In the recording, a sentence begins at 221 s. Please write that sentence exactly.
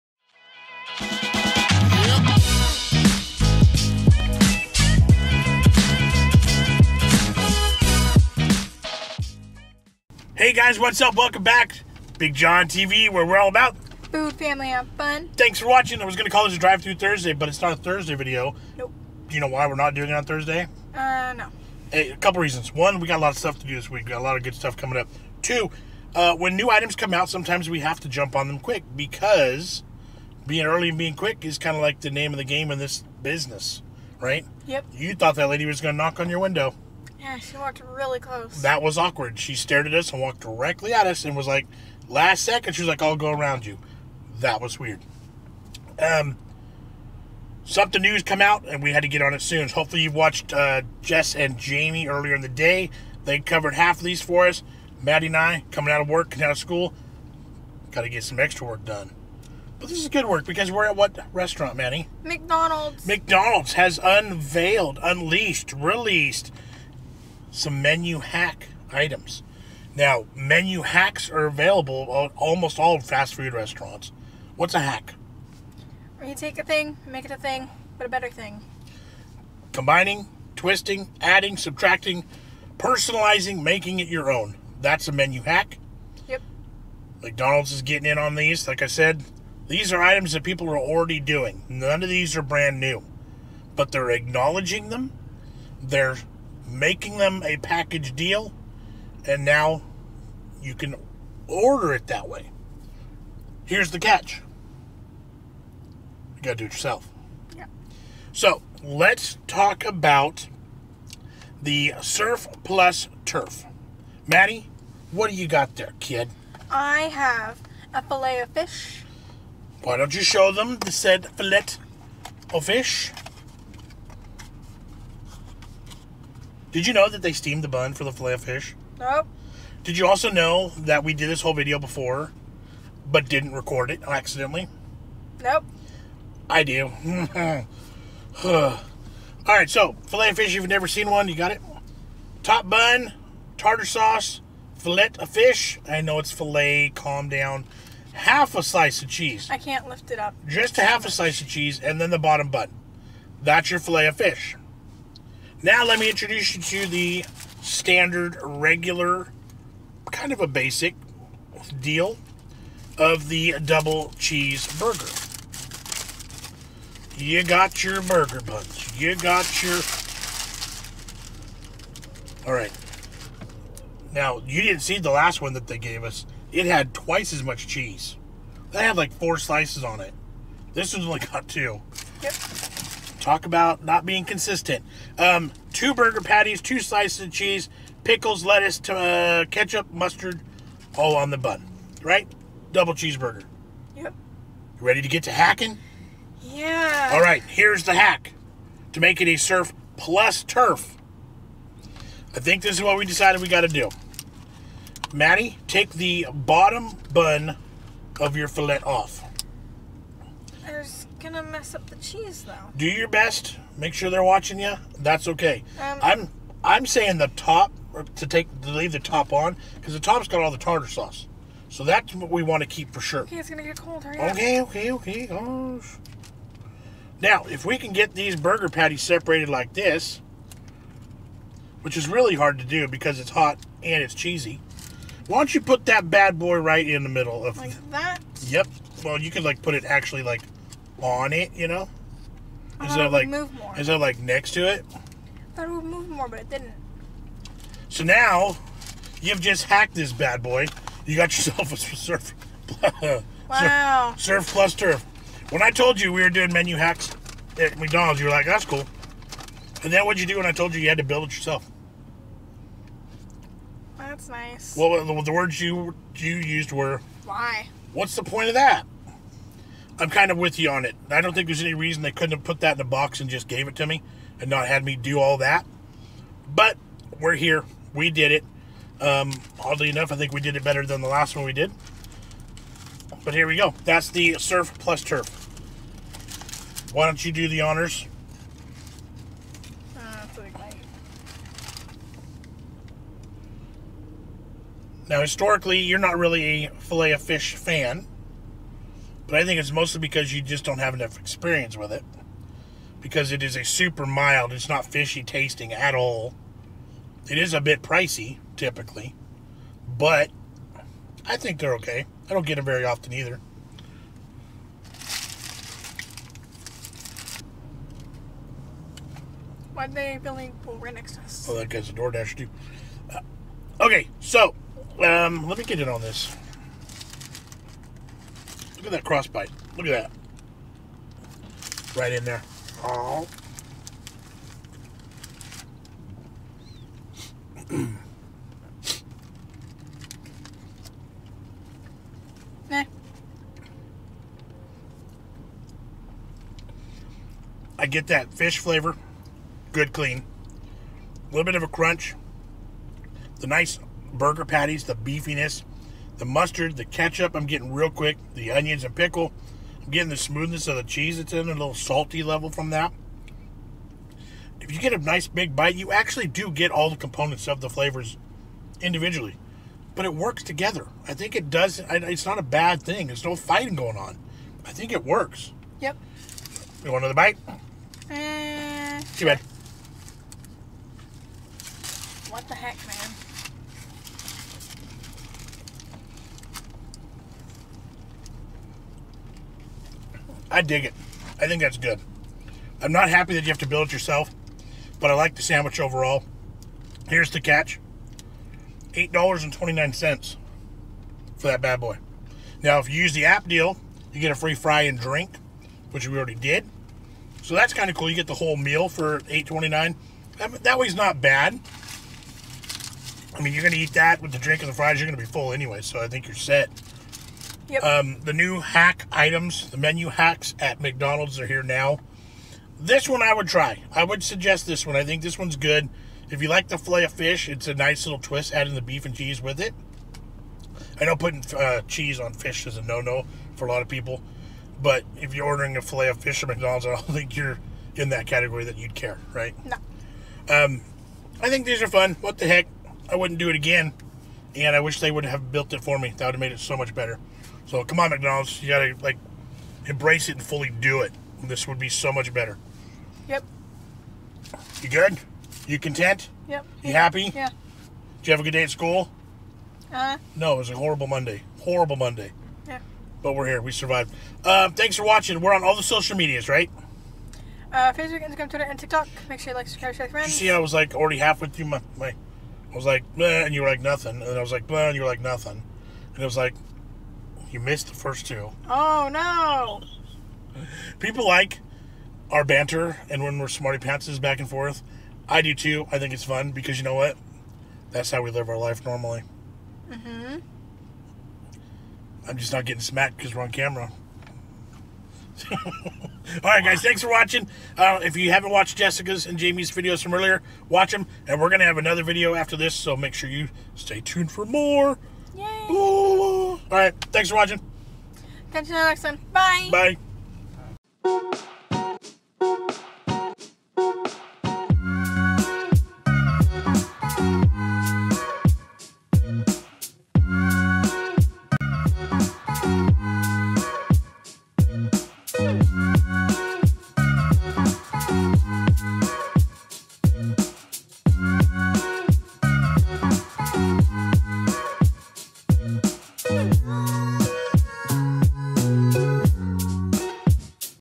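So that's what we want to keep for sure.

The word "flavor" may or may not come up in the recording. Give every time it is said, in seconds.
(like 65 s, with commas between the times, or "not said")
348 s, 367 s.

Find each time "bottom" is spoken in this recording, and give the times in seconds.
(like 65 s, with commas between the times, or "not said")
152 s, 206 s.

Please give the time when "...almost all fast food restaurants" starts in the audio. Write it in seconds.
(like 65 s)
72 s.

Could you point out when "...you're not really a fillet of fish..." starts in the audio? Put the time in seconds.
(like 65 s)
295 s.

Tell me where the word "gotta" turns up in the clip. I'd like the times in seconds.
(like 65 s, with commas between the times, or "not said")
106 s, 448 s.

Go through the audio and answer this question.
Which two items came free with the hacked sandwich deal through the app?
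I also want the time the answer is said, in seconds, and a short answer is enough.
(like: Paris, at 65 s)
fry and drink, at 404 s.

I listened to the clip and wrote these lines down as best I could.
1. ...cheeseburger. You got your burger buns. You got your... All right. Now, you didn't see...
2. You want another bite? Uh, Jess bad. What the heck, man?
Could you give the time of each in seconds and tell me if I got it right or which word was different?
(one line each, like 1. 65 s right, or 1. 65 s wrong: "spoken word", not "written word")
1. 164 s right
2. 376 s wrong: "Too", not "Jess".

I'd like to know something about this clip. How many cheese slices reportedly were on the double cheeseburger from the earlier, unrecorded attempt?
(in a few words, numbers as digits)
4.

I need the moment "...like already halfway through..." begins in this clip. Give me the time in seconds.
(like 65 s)
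470 s.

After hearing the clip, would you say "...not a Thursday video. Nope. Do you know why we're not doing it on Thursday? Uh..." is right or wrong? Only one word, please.
right.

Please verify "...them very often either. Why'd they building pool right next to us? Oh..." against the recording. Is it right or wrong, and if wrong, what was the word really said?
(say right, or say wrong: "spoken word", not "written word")
right.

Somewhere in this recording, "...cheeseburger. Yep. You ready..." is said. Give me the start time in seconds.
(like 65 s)
192 s.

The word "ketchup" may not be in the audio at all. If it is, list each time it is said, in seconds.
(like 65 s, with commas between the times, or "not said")
189 s, 356 s.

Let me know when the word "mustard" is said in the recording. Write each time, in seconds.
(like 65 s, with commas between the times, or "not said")
189 s, 356 s.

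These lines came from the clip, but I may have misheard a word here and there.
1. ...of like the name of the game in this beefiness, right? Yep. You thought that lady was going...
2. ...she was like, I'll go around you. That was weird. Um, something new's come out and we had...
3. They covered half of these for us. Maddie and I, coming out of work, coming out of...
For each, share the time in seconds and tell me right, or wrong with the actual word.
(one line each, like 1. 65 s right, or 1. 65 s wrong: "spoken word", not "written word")
1. 31 s wrong: "business", not "beefiness"
2. 42 s right
3. 53 s right.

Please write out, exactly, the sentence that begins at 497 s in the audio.
Uh, if you haven't watched Jessica's and Jamie's videos from earlier, watch them.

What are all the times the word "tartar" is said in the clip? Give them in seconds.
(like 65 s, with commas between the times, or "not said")
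143 s, 220 s.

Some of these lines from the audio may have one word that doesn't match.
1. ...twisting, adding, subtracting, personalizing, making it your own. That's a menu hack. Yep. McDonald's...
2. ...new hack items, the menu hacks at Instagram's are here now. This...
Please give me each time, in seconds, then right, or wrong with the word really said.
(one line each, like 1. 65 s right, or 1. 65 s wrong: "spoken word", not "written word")
1. 80 s right
2. 418 s wrong: "McDonald", not "Instagram".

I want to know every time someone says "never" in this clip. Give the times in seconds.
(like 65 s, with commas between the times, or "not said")
140 s.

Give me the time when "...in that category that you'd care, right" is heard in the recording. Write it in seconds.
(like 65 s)
437 s.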